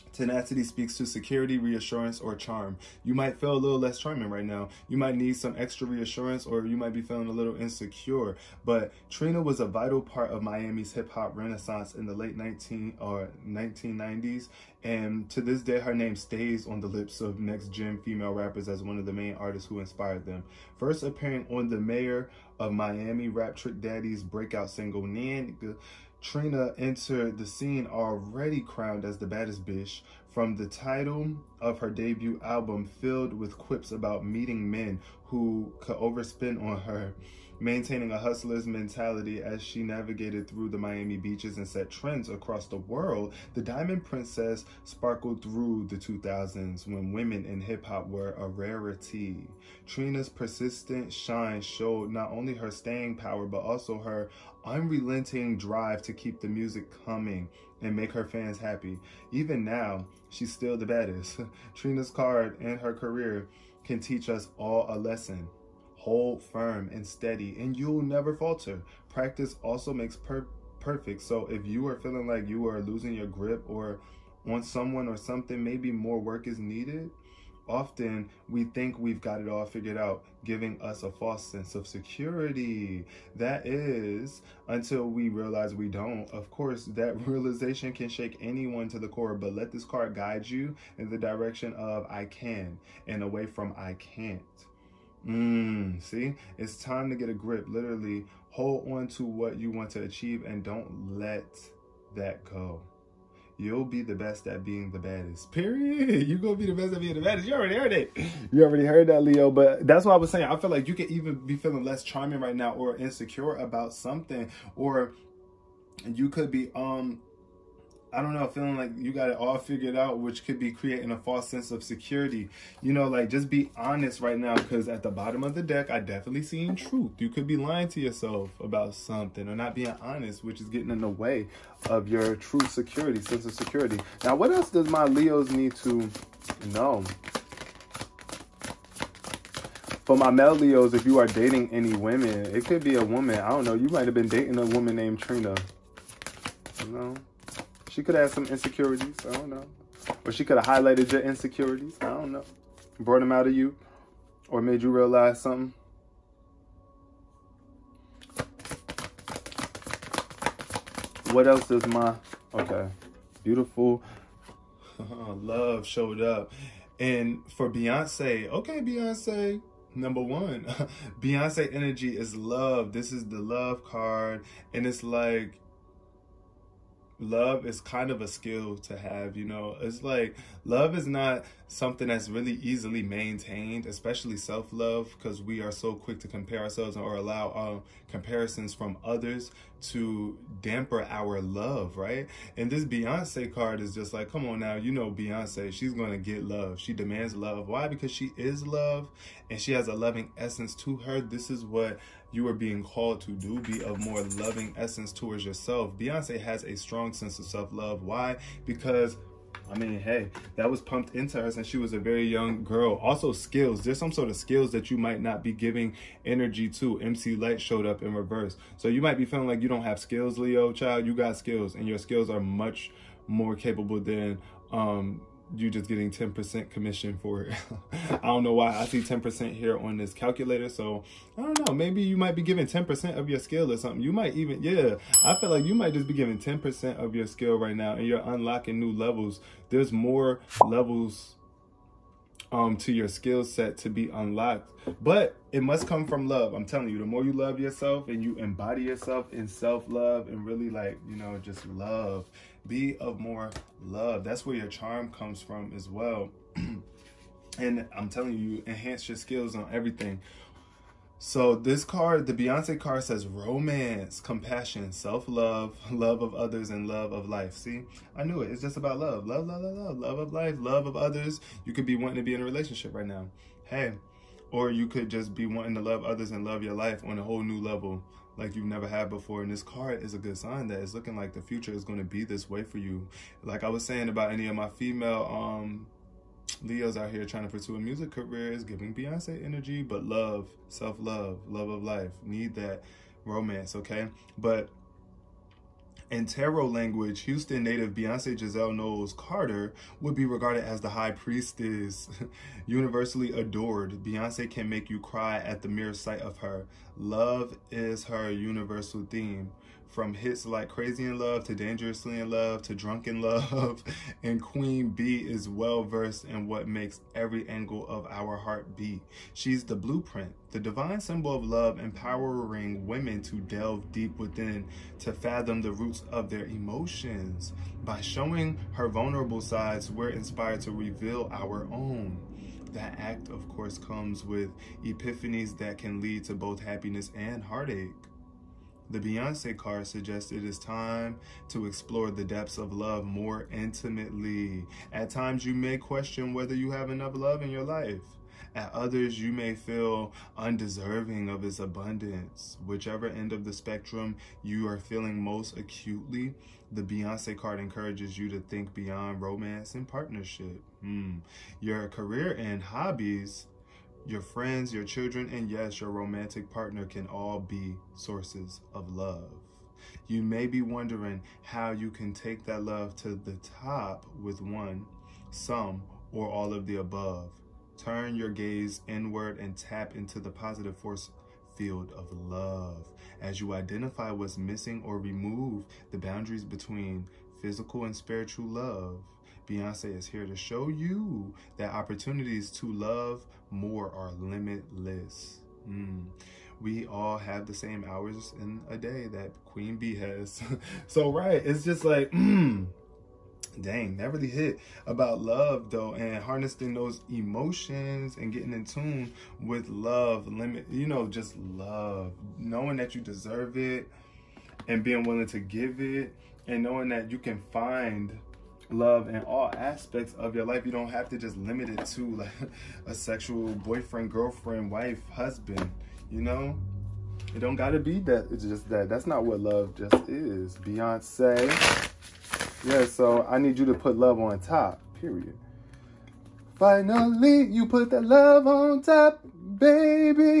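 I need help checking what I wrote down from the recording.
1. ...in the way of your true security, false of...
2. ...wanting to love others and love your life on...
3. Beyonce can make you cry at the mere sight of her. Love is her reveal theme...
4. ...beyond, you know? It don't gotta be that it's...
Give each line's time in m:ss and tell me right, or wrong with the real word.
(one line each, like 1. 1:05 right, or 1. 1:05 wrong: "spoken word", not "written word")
1. 2:10 wrong: "sense", not "false"
2. 4:35 right
3. 5:04 wrong: "universal", not "reveal"
4. 7:05 wrong: "husband", not "beyond".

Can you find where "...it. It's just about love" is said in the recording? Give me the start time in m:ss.
4:28.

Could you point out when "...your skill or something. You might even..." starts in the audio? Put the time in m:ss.
3:53.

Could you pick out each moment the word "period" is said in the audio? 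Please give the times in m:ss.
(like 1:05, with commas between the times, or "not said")
1:45, 7:14.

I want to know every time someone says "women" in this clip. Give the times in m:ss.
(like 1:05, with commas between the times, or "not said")
0:47, 2:21, 5:22.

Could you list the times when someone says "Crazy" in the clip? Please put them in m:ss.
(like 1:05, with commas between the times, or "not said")
5:10.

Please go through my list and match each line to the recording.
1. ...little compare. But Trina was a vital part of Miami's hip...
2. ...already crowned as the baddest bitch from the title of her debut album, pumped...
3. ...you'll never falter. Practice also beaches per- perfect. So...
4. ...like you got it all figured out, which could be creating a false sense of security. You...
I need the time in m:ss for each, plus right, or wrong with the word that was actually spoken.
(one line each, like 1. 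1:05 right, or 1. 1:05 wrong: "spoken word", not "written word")
1. 0:07 wrong: "insecure", not "compare"
2. 0:27 wrong: "filled", not "pumped"
3. 1:07 wrong: "makes", not "beaches"
4. 1:58 right.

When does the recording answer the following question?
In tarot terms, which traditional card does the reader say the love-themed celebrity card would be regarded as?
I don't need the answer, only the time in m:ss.
5:00.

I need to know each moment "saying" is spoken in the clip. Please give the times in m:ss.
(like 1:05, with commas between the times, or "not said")
1:50, 4:43.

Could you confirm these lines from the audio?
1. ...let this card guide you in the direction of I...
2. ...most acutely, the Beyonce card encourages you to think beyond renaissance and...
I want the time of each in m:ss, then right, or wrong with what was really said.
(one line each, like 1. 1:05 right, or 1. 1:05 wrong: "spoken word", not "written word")
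1. 1:29 right
2. 5:55 wrong: "romance", not "renaissance".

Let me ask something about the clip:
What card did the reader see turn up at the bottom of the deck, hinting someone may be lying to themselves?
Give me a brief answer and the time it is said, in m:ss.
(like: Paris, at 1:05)
Truth, at 2:06.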